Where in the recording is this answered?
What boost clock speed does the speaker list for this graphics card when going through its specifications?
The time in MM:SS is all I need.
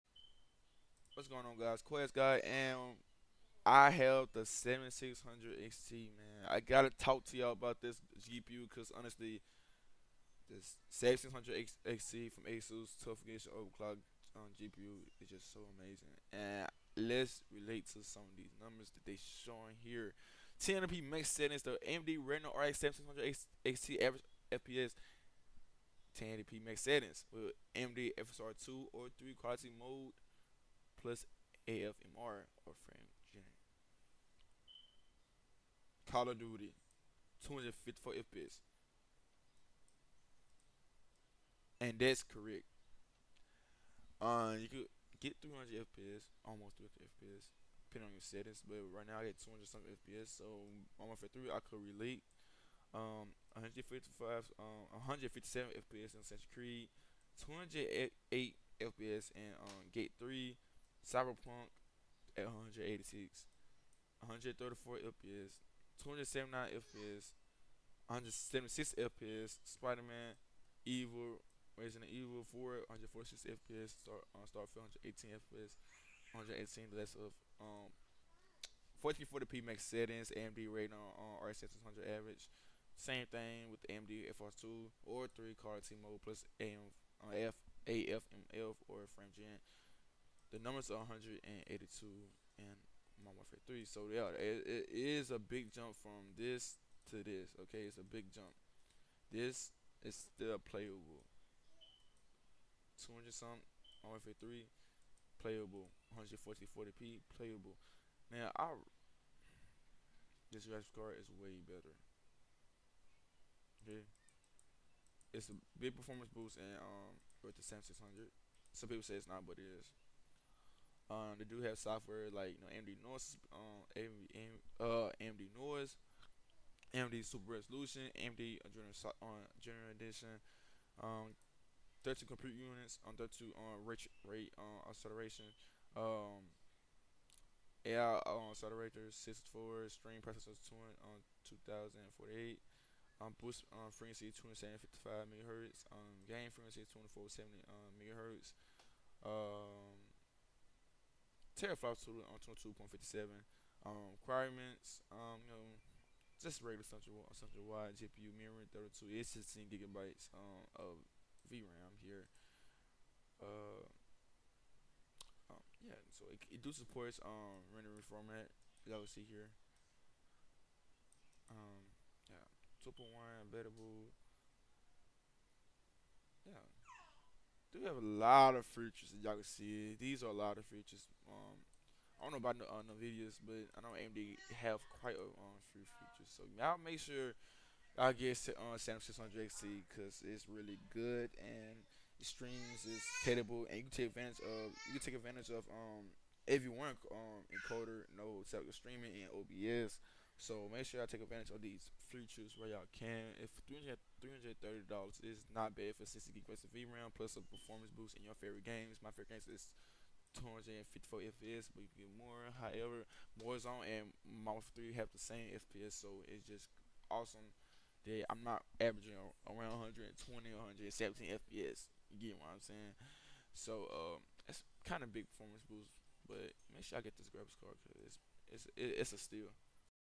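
02:24.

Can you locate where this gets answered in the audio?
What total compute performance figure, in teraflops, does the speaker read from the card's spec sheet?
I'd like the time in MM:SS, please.
02:32.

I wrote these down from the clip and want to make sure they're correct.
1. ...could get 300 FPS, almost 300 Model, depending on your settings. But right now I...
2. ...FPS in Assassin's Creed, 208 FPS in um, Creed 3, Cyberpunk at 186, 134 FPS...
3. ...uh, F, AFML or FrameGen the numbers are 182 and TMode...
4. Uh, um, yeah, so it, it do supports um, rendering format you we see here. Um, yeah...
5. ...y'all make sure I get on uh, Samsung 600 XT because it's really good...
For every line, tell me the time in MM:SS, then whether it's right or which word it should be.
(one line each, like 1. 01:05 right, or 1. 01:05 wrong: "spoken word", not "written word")
1. 00:44 wrong: "FPS", not "Model"
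2. 00:55 wrong: "Gate", not "Creed"
3. 01:27 wrong: "Modern", not "TMode"
4. 02:43 right
5. 03:06 right.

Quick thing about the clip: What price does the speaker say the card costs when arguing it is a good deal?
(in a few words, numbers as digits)
$330.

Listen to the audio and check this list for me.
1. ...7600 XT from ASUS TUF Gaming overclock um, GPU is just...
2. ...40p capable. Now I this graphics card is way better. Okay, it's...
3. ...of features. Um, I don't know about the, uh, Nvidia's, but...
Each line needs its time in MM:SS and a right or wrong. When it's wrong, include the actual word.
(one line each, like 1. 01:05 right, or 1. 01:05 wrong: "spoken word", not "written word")
1. 00:10 right
2. 01:46 wrong: "playable", not "capable"
3. 03:00 right.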